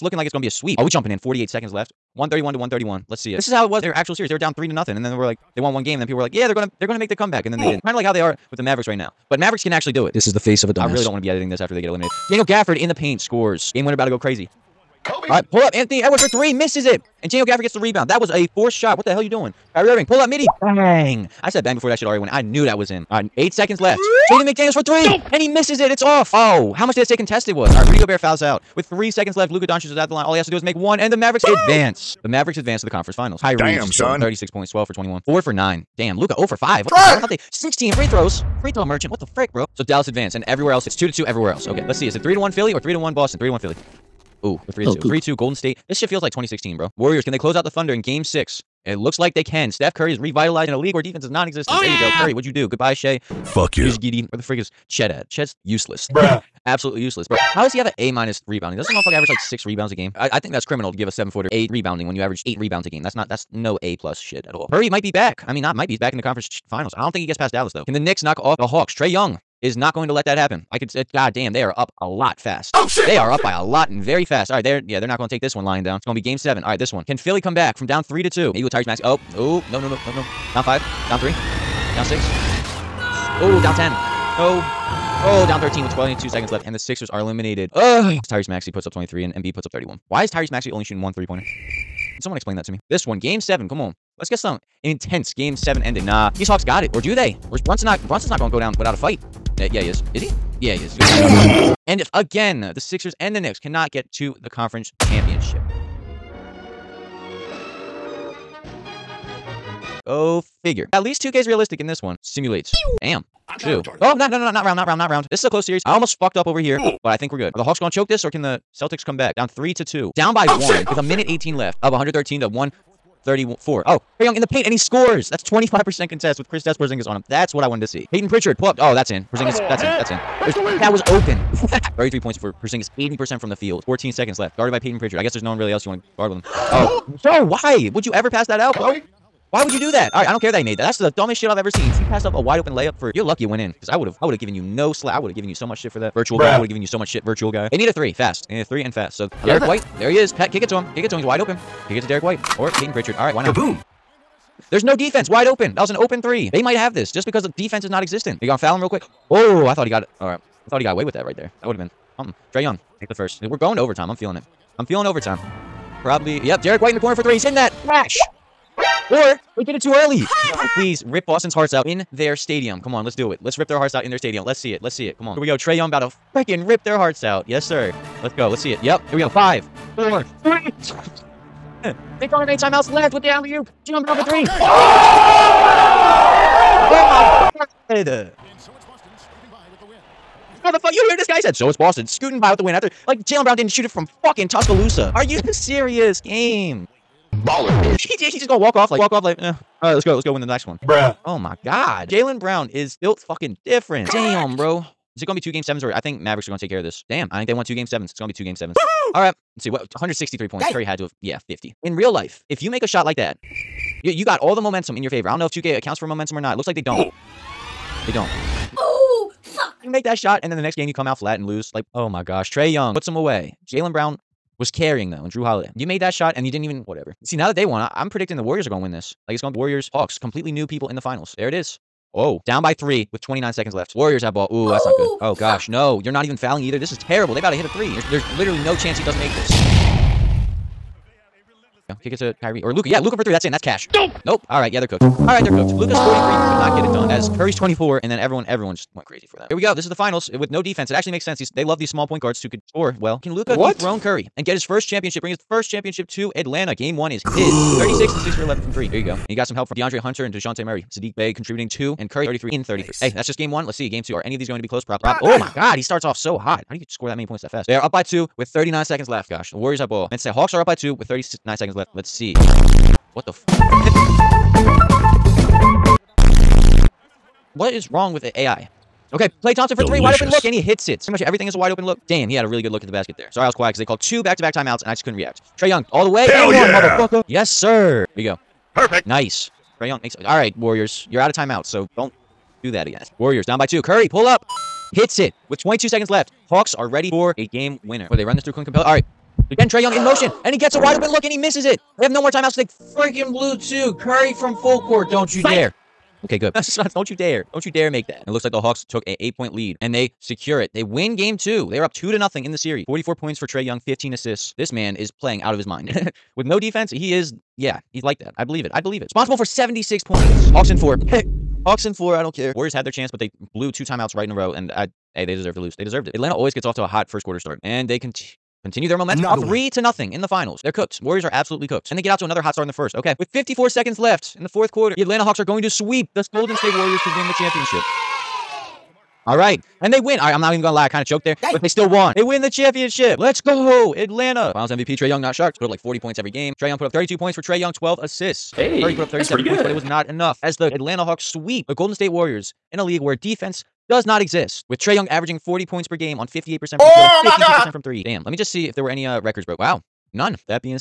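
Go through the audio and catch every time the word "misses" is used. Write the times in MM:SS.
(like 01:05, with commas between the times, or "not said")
00:16, 00:25, 05:01.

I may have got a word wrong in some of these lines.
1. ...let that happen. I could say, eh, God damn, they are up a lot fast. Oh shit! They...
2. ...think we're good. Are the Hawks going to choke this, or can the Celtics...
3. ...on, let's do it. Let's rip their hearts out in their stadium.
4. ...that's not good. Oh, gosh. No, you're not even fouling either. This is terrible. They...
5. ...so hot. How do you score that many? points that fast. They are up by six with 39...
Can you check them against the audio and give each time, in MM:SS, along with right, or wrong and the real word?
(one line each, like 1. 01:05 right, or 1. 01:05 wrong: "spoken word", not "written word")
1. 01:10 right
2. 01:57 right
3. 02:52 right
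4. 03:54 right
5. 04:26 wrong: "two", not "six".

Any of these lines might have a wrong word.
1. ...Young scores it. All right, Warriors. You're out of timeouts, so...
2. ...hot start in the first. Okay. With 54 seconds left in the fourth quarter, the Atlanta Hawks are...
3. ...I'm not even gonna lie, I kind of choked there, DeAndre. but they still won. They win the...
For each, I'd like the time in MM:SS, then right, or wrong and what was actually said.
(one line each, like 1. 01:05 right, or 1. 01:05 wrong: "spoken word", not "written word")
1. 04:49 wrong: "makes", not "scores"
2. 05:32 right
3. 05:40 wrong: "Dang", not "DeAndre".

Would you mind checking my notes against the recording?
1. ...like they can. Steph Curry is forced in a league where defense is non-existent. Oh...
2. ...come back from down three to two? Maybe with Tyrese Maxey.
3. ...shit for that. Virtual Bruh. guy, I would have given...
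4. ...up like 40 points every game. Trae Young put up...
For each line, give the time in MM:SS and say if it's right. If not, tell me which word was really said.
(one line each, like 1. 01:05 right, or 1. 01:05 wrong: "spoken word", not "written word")
1. 00:49 wrong: "revitalized", not "forced"
2. 01:17 right
3. 02:25 right
4. 05:45 right.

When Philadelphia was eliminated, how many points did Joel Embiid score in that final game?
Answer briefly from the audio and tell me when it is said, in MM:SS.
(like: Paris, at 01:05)
31, at 01:29.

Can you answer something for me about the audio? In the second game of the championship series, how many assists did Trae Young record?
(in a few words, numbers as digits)
15.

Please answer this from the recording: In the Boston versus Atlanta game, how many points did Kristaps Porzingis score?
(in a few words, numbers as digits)
33.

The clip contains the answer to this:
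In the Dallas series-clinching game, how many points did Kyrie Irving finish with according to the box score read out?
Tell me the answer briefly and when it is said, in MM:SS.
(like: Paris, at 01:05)
36, at 00:34.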